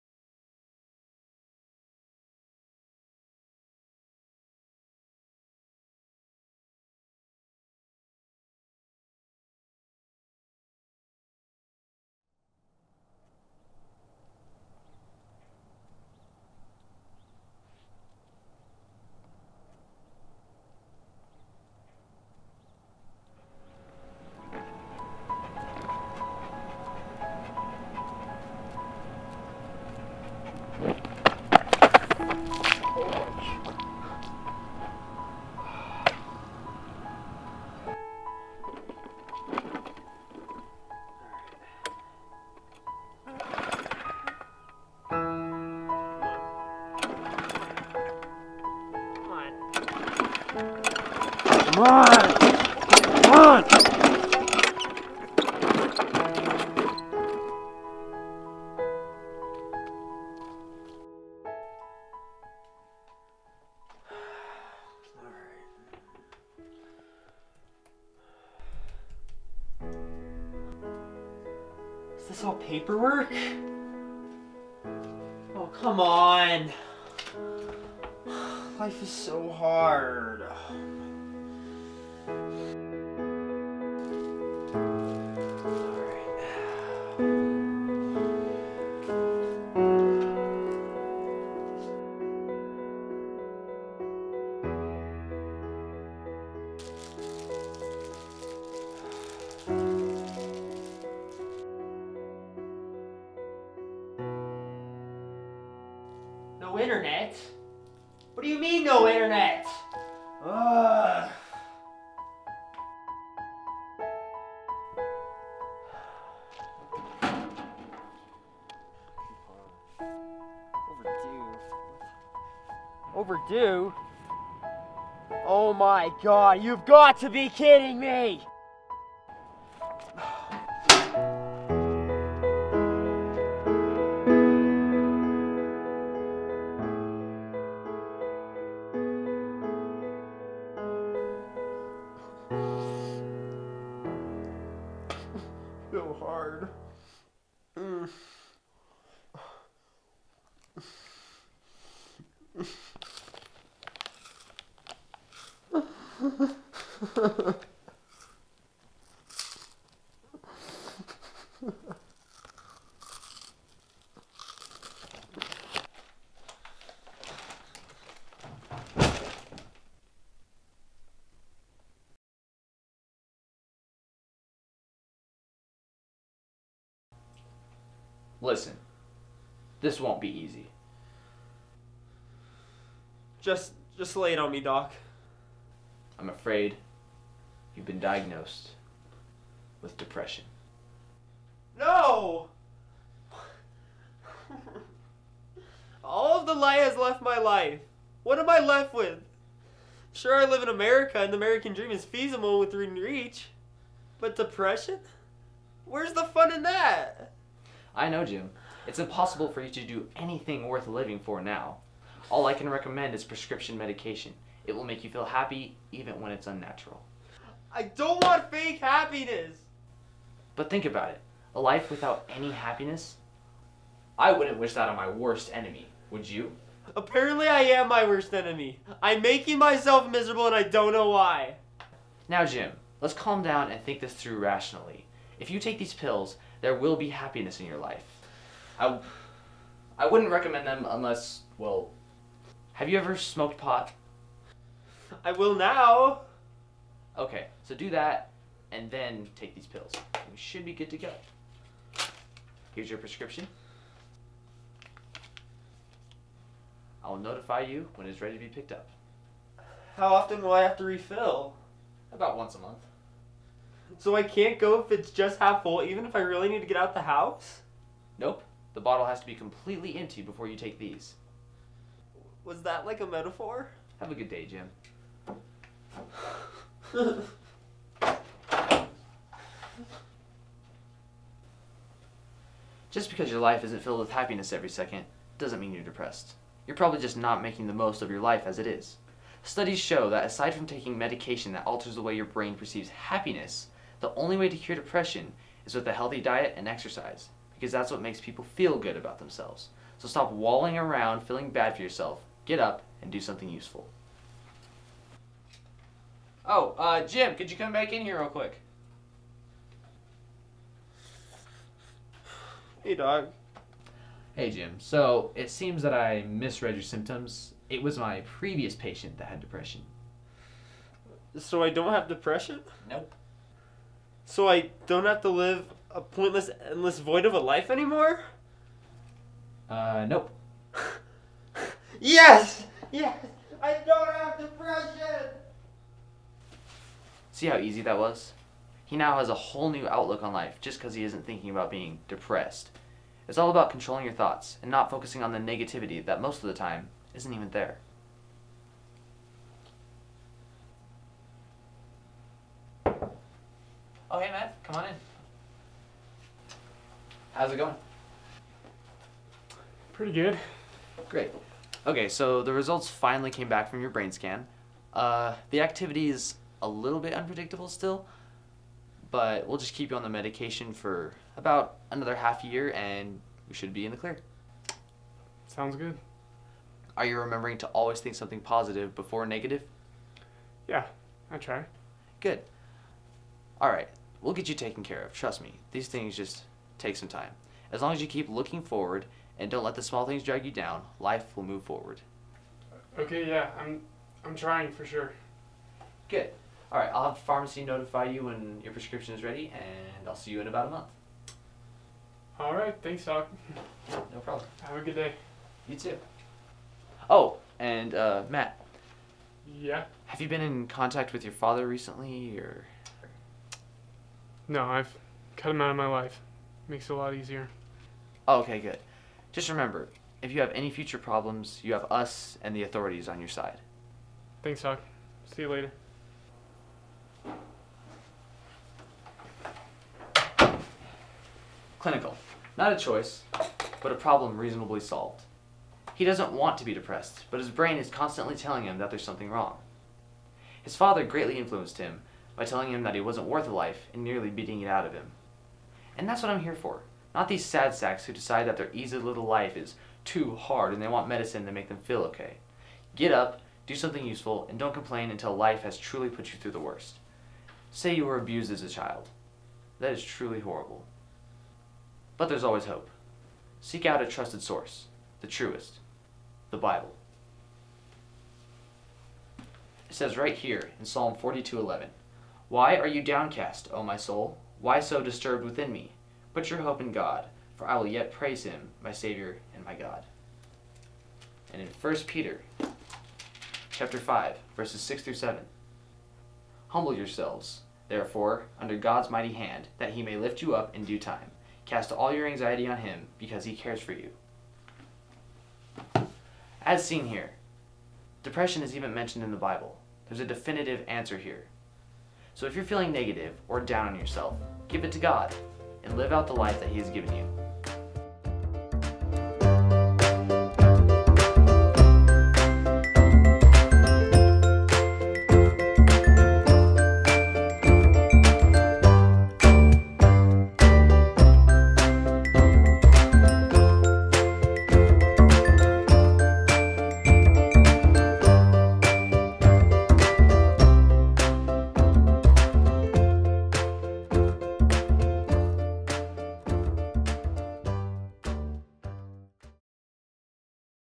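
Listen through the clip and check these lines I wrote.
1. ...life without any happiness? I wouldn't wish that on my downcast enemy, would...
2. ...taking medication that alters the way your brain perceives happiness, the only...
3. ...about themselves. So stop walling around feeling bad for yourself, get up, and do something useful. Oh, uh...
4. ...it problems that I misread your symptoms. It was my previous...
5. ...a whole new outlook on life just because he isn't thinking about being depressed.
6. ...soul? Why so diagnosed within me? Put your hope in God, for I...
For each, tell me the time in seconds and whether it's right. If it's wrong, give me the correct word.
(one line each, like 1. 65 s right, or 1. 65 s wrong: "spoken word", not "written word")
1. 221 s wrong: "worst", not "downcast"
2. 290 s right
3. 298 s right
4. 315 s wrong: "seems", not "problems"
5. 339 s right
6. 473 s wrong: "disturbed", not "diagnosed".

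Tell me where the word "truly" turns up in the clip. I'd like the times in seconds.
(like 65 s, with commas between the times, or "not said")
455 s, 460 s.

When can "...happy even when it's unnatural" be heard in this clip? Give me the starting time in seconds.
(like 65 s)
215 s.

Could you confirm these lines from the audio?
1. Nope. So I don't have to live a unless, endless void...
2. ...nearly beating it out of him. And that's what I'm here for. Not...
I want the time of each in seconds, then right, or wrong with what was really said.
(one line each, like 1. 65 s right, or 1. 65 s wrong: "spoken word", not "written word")
1. 322 s wrong: "pointless", not "unless"
2. 444 s right.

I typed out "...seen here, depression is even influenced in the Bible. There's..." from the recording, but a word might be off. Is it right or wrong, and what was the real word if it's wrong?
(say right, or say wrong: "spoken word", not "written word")
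wrong: "mentioned", not "influenced".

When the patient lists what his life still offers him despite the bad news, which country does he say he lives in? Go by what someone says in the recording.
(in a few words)
America.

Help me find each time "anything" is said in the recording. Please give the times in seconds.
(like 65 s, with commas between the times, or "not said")
210 s.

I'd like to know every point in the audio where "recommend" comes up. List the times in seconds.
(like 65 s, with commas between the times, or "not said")
212 s, 240 s.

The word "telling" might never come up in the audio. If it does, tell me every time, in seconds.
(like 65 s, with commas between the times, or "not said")
438 s, 442 s.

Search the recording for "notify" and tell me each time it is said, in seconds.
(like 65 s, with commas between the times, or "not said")
257 s, 397 s.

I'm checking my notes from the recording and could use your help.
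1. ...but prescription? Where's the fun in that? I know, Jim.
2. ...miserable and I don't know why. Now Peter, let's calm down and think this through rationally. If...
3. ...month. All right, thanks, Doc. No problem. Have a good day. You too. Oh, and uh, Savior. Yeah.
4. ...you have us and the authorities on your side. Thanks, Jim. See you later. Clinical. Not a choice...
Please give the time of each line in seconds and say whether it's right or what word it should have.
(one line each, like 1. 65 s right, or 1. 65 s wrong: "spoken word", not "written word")
1. 204 s wrong: "depression", not "prescription"
2. 230 s wrong: "Jim", not "Peter"
3. 400 s wrong: "Matt", not "Savior"
4. 421 s wrong: "Doc", not "Jim".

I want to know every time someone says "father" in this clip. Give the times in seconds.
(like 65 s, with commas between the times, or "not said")
411 s, 440 s.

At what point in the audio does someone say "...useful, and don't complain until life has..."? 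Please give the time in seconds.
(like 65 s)
454 s.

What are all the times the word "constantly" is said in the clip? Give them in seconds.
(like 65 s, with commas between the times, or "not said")
437 s.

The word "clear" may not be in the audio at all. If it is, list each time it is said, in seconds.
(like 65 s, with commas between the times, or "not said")
373 s.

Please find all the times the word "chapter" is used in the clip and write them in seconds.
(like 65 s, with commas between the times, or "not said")
483 s.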